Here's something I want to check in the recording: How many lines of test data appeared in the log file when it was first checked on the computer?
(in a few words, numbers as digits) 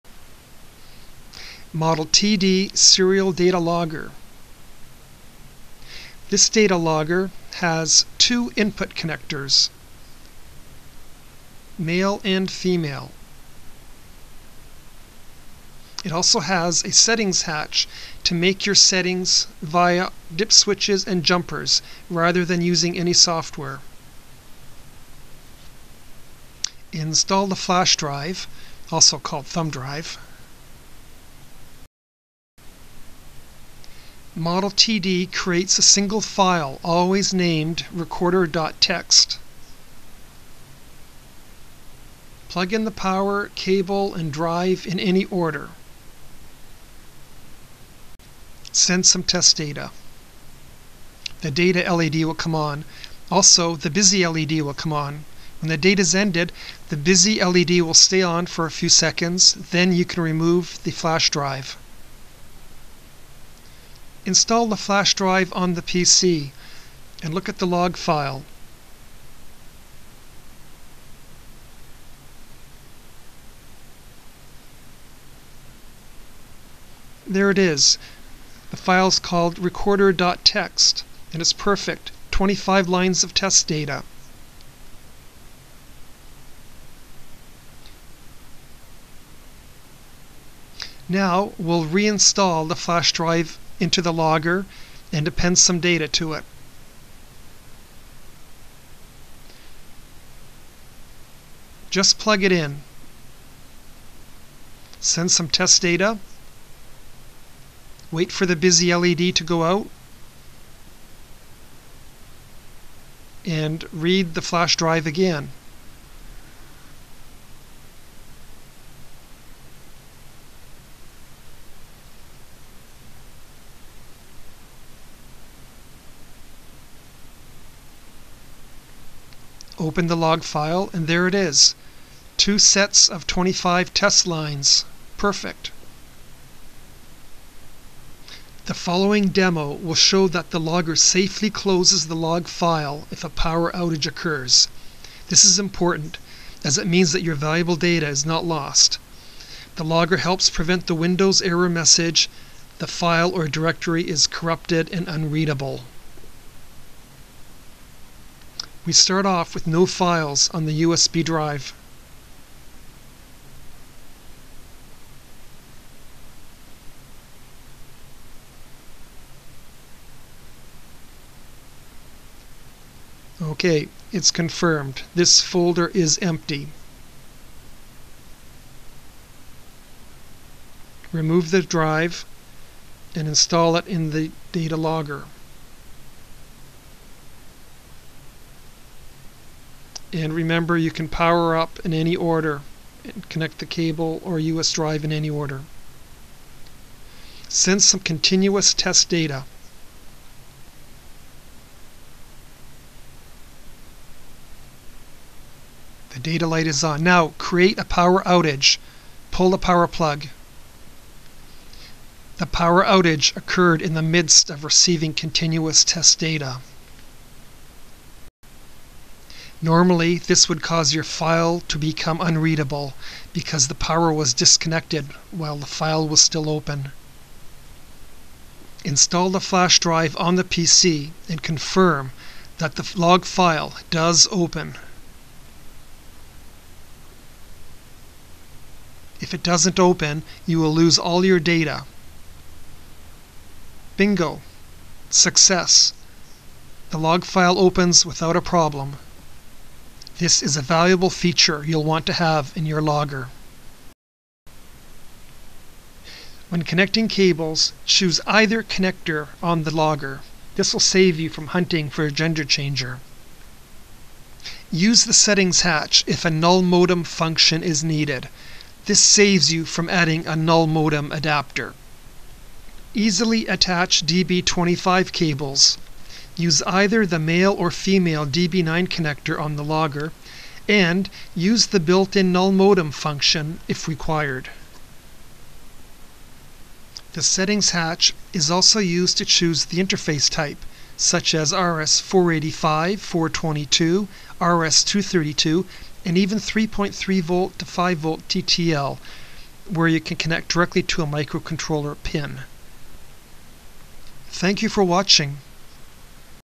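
25.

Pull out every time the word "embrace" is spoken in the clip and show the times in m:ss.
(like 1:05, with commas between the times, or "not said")
not said.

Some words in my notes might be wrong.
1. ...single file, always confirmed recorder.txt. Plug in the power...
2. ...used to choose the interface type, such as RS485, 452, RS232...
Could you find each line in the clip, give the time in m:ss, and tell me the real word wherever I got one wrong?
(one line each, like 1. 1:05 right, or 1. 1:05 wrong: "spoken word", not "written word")
1. 0:35 wrong: "named", not "confirmed"
2. 4:48 wrong: "422", not "452".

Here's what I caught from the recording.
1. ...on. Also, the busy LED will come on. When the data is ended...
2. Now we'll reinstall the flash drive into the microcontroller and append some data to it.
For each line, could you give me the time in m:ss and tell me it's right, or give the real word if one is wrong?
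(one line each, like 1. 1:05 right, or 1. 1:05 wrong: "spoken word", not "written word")
1. 0:52 right
2. 1:31 wrong: "logger", not "microcontroller".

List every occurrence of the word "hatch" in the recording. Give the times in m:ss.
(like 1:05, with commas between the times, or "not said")
0:17, 4:25, 4:47.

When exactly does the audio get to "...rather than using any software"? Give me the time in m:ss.
0:22.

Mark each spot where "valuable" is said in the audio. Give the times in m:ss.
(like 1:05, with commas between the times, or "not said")
2:27, 4:10.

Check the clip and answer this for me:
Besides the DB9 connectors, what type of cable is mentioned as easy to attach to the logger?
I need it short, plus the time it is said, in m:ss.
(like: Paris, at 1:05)
DB25, at 4:34.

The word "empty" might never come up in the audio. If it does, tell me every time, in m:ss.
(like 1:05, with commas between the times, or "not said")
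2:56.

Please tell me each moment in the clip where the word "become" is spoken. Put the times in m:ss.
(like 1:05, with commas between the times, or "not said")
3:41.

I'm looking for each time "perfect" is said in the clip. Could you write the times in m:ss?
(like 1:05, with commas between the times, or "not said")
1:21, 2:15.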